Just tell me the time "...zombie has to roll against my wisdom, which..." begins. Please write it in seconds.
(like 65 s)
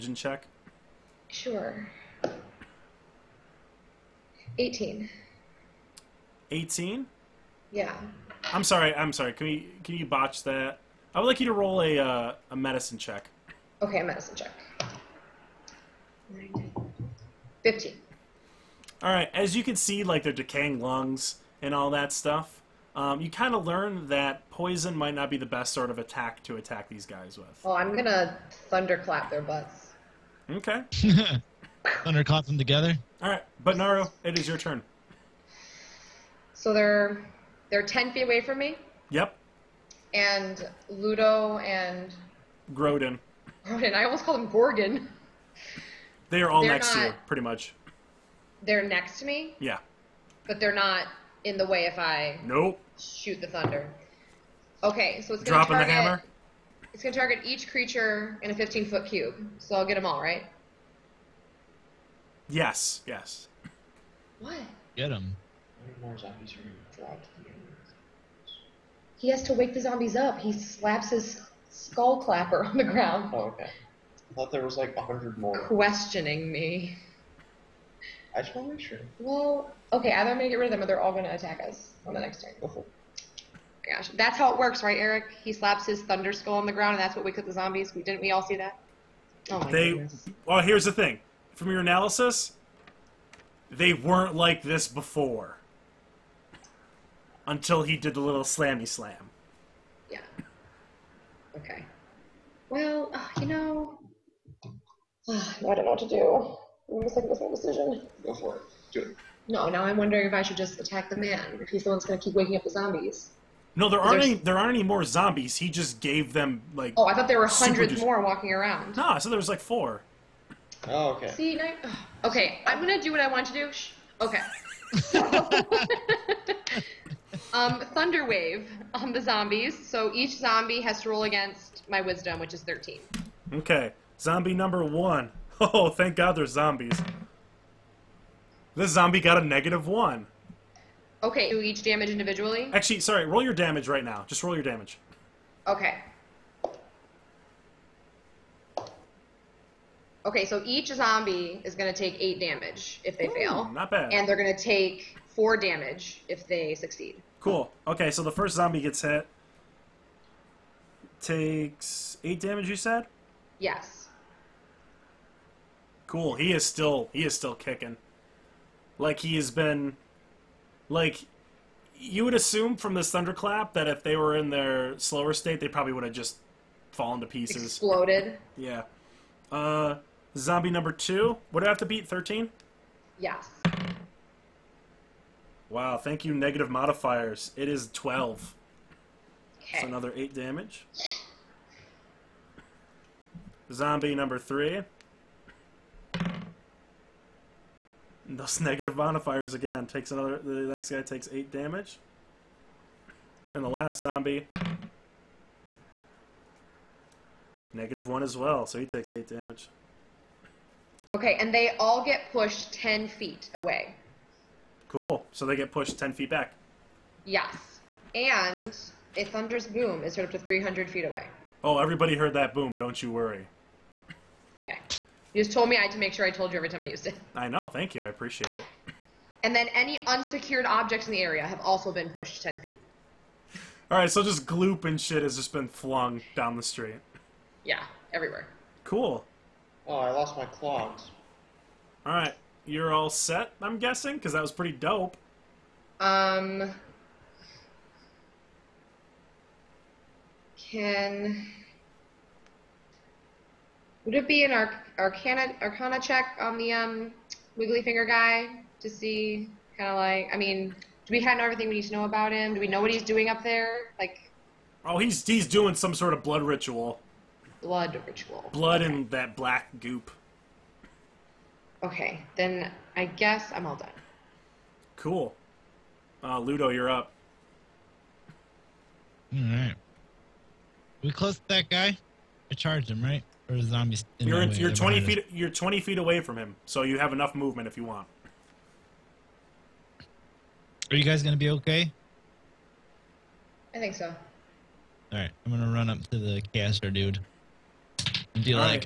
130 s.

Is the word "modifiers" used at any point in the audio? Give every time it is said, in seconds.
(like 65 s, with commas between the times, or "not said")
186 s, 198 s.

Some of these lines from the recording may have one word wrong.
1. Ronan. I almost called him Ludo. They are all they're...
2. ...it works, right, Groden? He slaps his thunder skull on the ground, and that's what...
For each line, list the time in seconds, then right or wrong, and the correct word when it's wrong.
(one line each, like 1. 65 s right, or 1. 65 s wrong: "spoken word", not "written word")
1. 43 s wrong: "Gorgon", not "Ludo"
2. 84 s wrong: "Eric", not "Groden".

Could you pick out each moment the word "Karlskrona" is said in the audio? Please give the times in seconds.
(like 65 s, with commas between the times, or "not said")
not said.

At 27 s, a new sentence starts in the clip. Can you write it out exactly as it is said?
Oh, I'm going to thunderclap their butts.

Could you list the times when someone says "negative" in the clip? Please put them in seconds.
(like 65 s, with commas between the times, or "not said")
139 s, 186 s, 198 s, 207 s.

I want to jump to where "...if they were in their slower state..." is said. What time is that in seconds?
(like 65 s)
173 s.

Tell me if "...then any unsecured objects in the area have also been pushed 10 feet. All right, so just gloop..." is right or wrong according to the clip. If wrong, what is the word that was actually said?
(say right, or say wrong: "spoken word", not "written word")
right.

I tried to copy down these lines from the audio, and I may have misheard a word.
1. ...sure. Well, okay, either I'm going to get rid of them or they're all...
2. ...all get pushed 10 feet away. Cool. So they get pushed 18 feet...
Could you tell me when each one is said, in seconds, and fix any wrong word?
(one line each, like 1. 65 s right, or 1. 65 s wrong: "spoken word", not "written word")
1. 78 s right
2. 211 s wrong: "10", not "18".